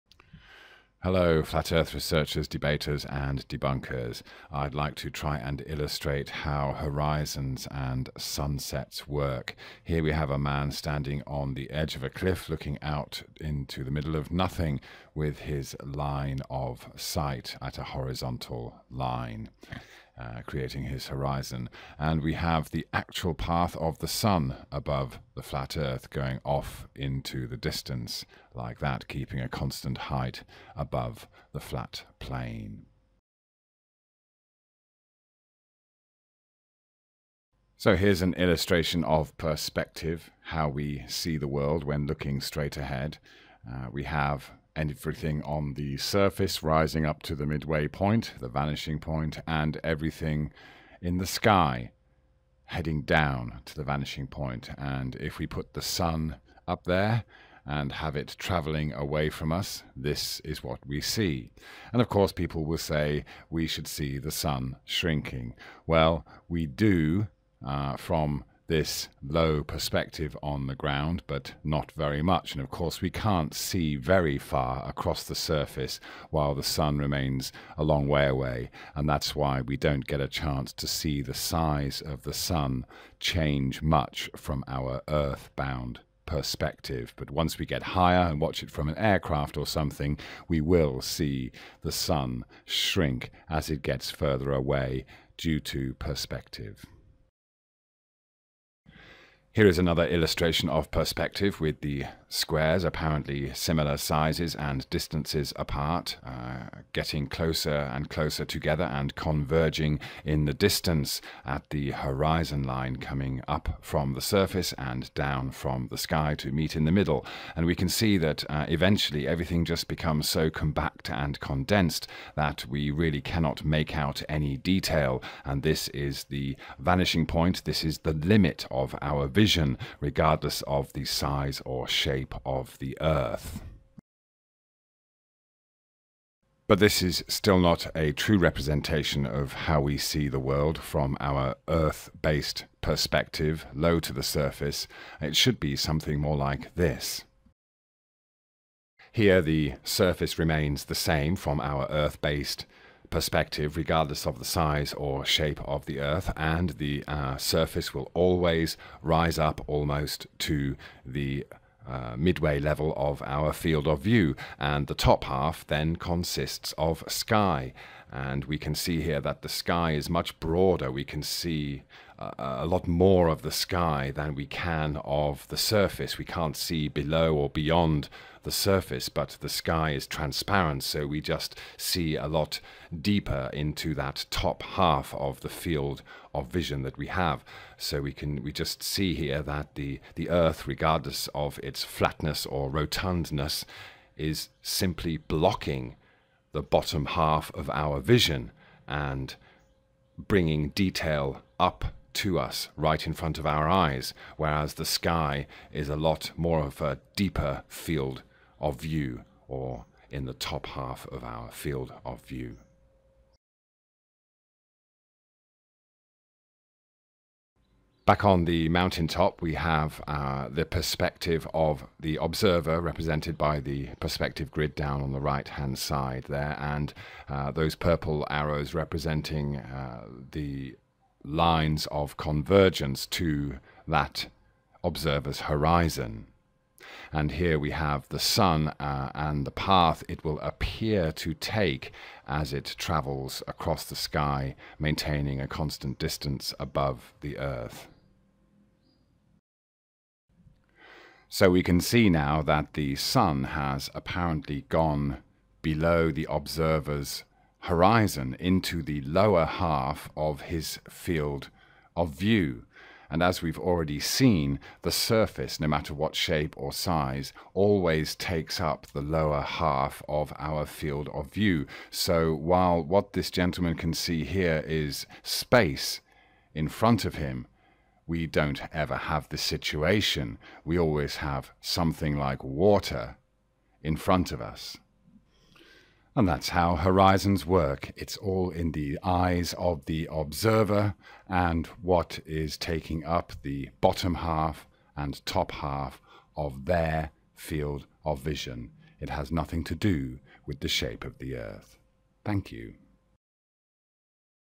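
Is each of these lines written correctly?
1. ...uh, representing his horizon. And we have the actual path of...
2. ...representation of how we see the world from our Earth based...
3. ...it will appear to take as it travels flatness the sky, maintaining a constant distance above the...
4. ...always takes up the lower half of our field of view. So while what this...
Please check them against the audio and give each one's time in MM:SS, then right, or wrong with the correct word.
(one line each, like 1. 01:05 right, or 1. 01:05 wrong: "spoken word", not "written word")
1. 00:20 wrong: "creating", not "representing"
2. 02:18 right
3. 04:00 wrong: "across", not "flatness"
4. 04:27 right.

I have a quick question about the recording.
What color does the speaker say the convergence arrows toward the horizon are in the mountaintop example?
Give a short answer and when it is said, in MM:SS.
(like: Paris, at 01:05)
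Purple, at 03:47.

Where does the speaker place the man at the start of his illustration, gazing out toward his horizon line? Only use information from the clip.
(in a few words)
On the edge of a cliff.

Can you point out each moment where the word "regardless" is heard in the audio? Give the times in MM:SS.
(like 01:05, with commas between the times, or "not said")
02:09, 02:33, 03:10.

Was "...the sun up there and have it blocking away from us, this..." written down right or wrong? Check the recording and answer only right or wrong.
wrong.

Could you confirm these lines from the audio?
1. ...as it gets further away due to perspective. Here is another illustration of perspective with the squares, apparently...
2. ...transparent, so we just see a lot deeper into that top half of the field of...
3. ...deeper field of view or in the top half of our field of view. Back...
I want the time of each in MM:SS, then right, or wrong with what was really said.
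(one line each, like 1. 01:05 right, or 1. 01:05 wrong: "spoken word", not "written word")
1. 01:33 right
2. 03:00 right
3. 03:27 right.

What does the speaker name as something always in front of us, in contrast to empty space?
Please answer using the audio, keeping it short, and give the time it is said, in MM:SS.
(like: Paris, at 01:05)
Water, at 04:42.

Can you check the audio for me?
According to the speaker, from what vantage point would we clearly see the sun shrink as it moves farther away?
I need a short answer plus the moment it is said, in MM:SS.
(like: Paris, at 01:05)
An aircraft, at 01:28.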